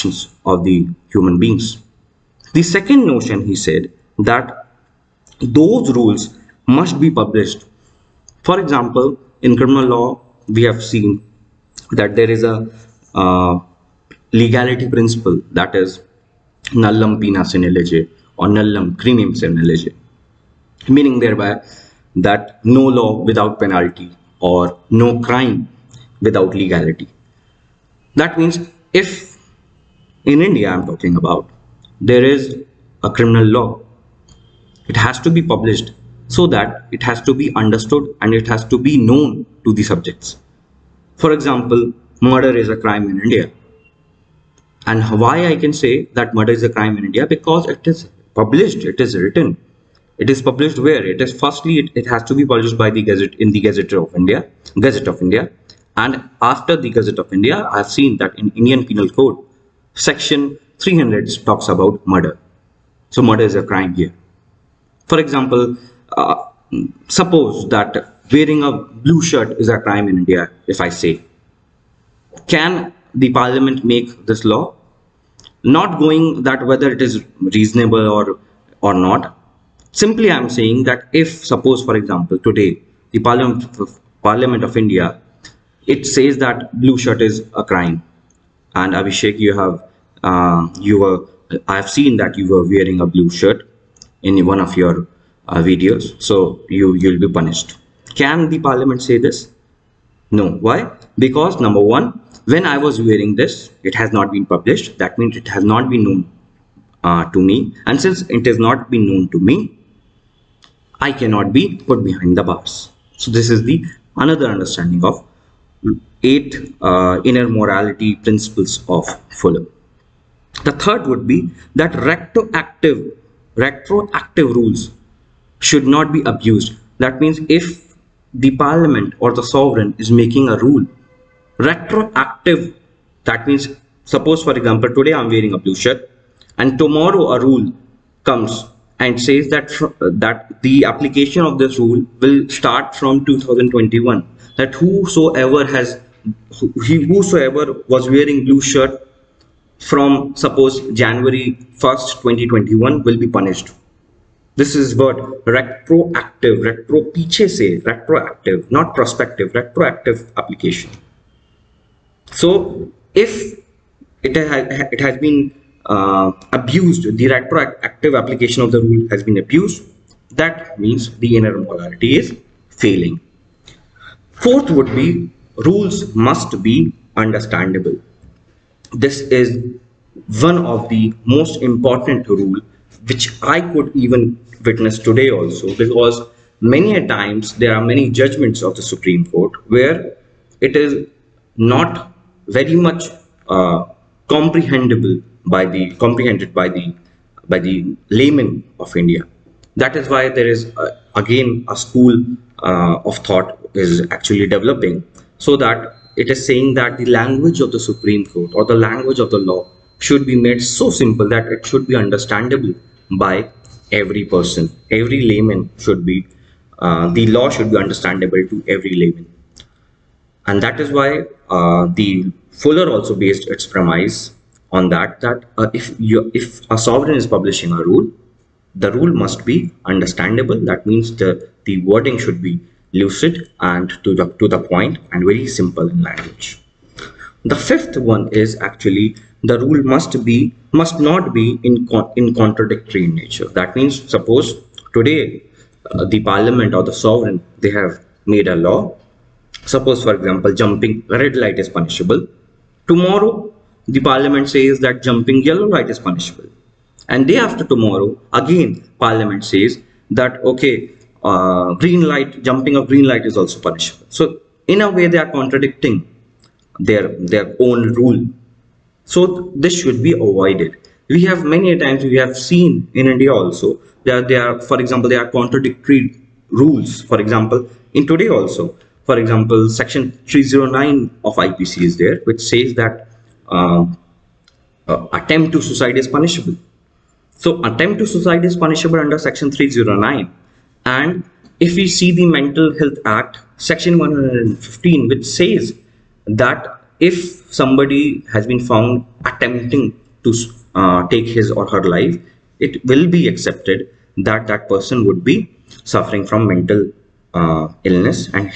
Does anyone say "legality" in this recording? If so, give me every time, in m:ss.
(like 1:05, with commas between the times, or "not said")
0:14, 0:26.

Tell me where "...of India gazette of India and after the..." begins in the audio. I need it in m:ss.
0:53.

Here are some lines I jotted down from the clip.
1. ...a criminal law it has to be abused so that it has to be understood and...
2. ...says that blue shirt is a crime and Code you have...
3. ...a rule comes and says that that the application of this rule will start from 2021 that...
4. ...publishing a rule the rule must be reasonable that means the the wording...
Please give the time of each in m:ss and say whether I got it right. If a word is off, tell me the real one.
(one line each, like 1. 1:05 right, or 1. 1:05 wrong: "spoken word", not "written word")
1. 0:33 wrong: "published", not "abused"
2. 1:26 wrong: "Abhishek", not "Code"
3. 2:17 right
4. 3:47 wrong: "understandable", not "reasonable".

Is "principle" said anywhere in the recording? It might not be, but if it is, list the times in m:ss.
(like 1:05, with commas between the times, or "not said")
0:14, 1:58.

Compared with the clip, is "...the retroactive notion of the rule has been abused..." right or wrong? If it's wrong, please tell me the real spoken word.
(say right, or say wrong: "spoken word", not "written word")
wrong: "application", not "notion".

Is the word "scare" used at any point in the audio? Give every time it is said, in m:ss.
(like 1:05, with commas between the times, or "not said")
not said.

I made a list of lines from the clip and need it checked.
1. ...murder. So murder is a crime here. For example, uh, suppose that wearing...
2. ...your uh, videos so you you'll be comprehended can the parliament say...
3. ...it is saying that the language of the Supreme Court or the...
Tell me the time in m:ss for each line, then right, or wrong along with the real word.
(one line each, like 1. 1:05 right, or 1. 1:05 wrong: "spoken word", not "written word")
1. 1:02 right
2. 1:34 wrong: "punished", not "comprehended"
3. 3:26 right.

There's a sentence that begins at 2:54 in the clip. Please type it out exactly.
Fourth would be rules must be understandable.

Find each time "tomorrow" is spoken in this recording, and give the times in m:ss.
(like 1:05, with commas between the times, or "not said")
2:16, 4:12, 4:17.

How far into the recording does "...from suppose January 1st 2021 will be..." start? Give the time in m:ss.
2:29.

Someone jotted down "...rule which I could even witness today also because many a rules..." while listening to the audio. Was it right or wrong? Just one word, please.
wrong.